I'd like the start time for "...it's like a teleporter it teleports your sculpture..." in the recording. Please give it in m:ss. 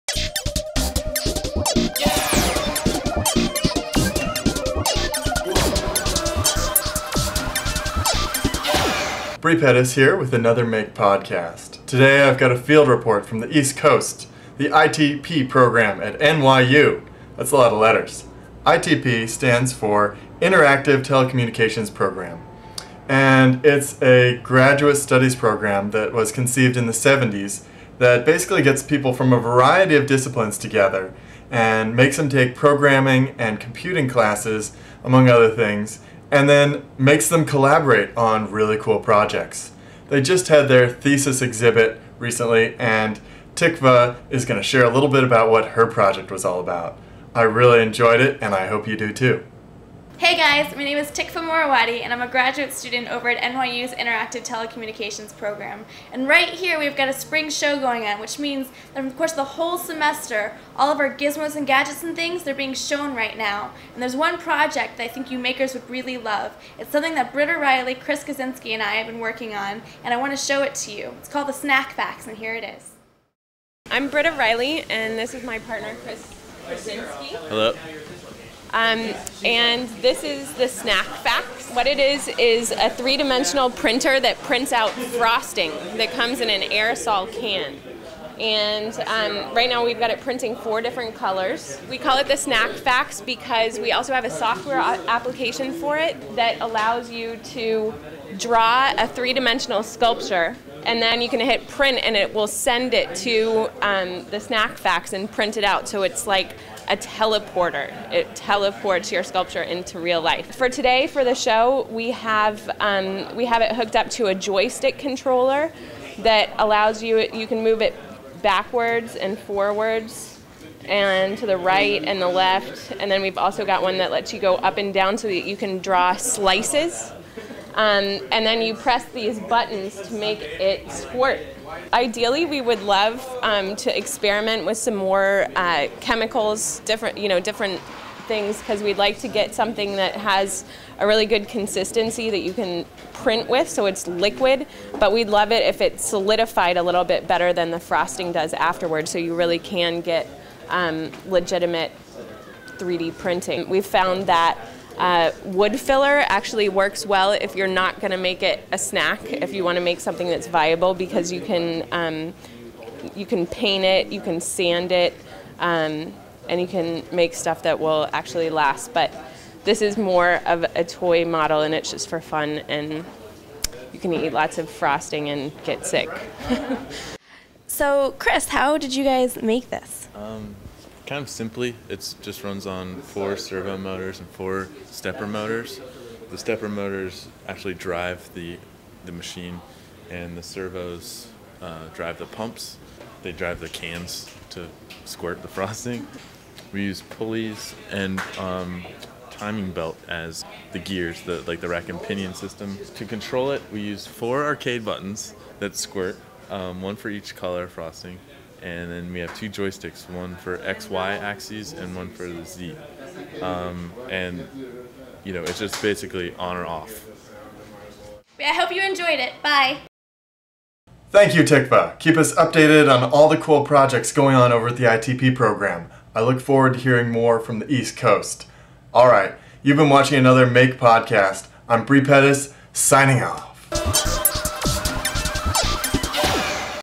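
1:46.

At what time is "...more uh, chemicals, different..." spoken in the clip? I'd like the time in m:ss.
2:14.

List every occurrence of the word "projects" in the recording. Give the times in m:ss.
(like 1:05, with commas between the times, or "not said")
0:38, 0:45, 1:04, 3:43.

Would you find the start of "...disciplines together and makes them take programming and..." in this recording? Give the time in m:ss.
0:30.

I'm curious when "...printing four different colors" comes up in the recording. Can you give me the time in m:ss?
1:30.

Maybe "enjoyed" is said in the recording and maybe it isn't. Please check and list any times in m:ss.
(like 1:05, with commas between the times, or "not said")
0:47, 3:38.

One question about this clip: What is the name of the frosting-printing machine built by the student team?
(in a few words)
Snackfax.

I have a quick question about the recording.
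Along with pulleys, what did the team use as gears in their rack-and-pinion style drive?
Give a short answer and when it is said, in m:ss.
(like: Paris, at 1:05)
timing belt, at 3:19.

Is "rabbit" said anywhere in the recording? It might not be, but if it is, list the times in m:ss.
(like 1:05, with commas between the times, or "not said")
not said.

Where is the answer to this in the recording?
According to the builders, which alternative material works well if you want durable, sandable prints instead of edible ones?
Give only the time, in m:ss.
2:35.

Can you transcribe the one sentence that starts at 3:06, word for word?
The stepper motors actually drive the, the machine, and the servos uh, drive the pumps.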